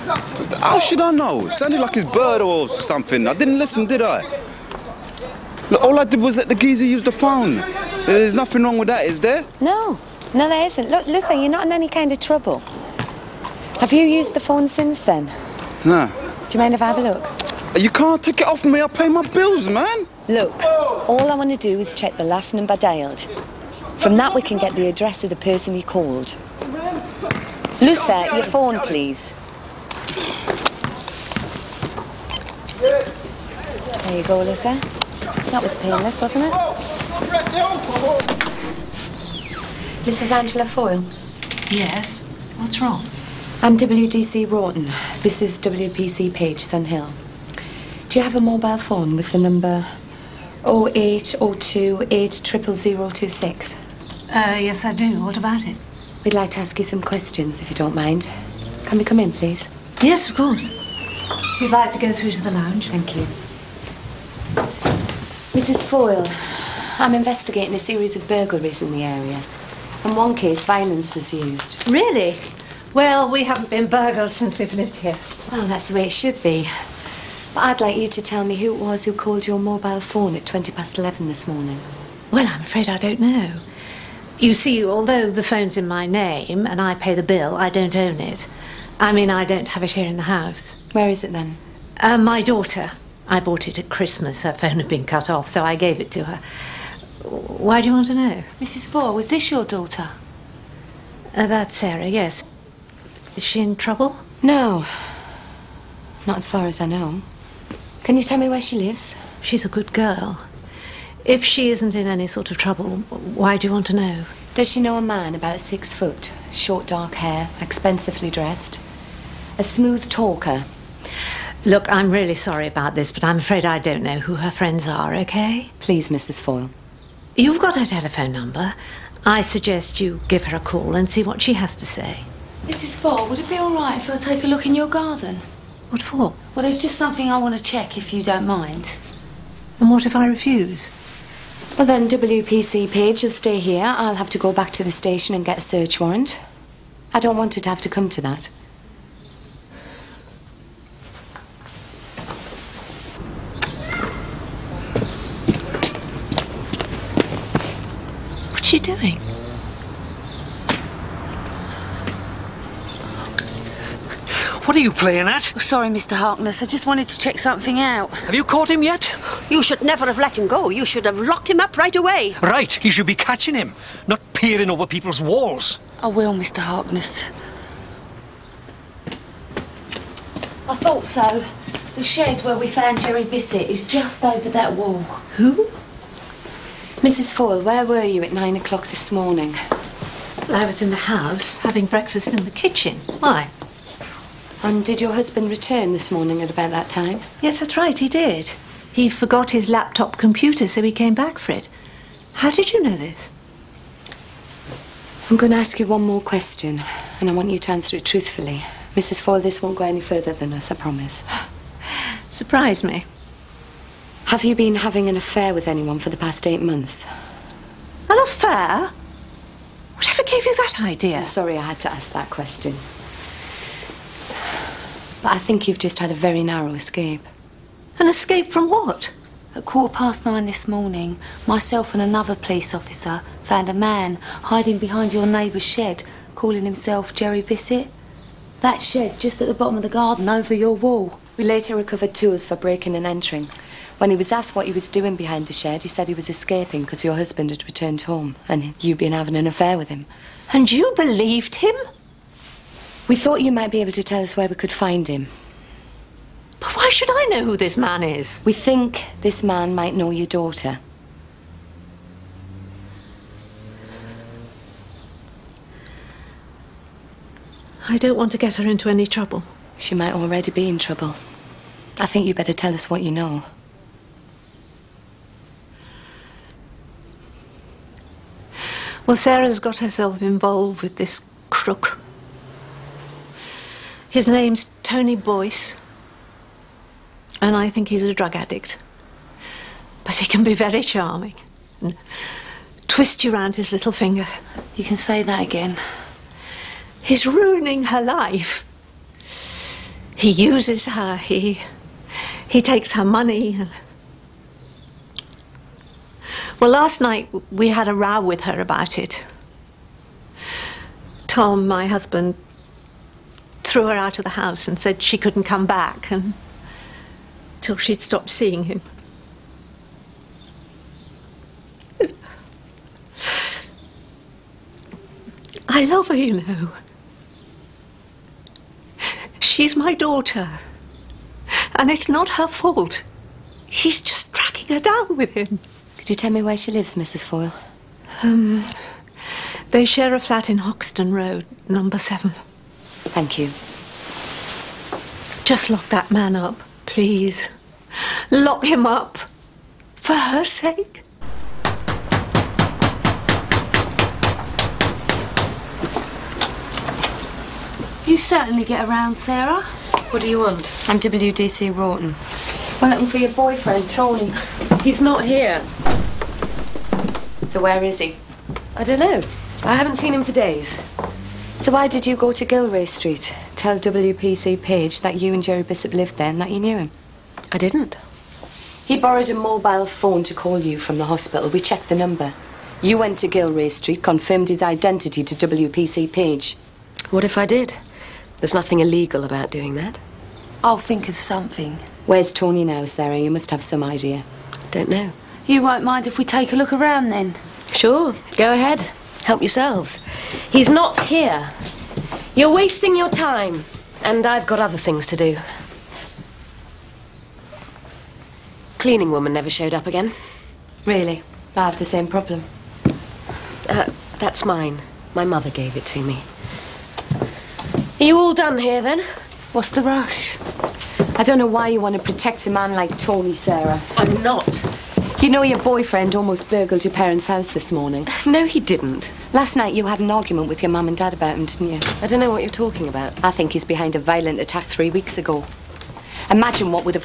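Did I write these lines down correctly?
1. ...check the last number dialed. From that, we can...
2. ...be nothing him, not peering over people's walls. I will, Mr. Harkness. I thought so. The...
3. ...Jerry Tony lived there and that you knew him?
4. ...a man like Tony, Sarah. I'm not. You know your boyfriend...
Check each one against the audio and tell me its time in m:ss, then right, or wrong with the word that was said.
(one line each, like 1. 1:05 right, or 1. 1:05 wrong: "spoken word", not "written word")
1. 0:21 right
2. 2:53 wrong: "catching", not "nothing"
3. 6:15 wrong: "Bishop", not "Tony"
4. 7:02 right.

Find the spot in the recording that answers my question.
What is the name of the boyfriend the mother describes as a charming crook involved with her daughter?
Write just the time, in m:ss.
4:44.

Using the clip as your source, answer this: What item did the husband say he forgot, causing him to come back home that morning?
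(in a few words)
Laptop computer.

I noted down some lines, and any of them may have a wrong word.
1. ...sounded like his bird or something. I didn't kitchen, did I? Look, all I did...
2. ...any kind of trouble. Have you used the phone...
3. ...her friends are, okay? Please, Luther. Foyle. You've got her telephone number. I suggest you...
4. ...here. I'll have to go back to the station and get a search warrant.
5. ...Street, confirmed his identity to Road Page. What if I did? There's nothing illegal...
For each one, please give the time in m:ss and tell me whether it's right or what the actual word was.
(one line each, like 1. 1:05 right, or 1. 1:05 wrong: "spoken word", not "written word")
1. 0:01 wrong: "listen", not "kitchen"
2. 0:11 right
3. 2:04 wrong: "Mrs", not "Luther"
4. 2:23 right
5. 6:23 wrong: "WPC", not "Road".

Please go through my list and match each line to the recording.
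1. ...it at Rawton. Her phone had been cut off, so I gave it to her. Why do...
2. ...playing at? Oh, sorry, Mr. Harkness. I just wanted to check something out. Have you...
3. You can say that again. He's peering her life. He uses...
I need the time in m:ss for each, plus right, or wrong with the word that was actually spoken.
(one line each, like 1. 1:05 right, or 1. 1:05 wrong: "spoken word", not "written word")
1. 1:33 wrong: "Christmas", not "Rawton"
2. 2:44 right
3. 4:54 wrong: "ruining", not "peering".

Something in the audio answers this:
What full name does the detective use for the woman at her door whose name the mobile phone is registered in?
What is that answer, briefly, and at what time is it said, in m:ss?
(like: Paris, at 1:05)
Angela Foyle, at 0:40.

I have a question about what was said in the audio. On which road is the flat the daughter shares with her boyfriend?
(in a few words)
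Hoxton Road.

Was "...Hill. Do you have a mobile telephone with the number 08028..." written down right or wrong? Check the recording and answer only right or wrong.
wrong.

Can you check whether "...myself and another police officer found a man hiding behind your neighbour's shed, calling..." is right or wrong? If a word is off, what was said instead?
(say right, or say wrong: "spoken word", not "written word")
right.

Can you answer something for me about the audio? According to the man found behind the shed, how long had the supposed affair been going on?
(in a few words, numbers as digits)
Eight months.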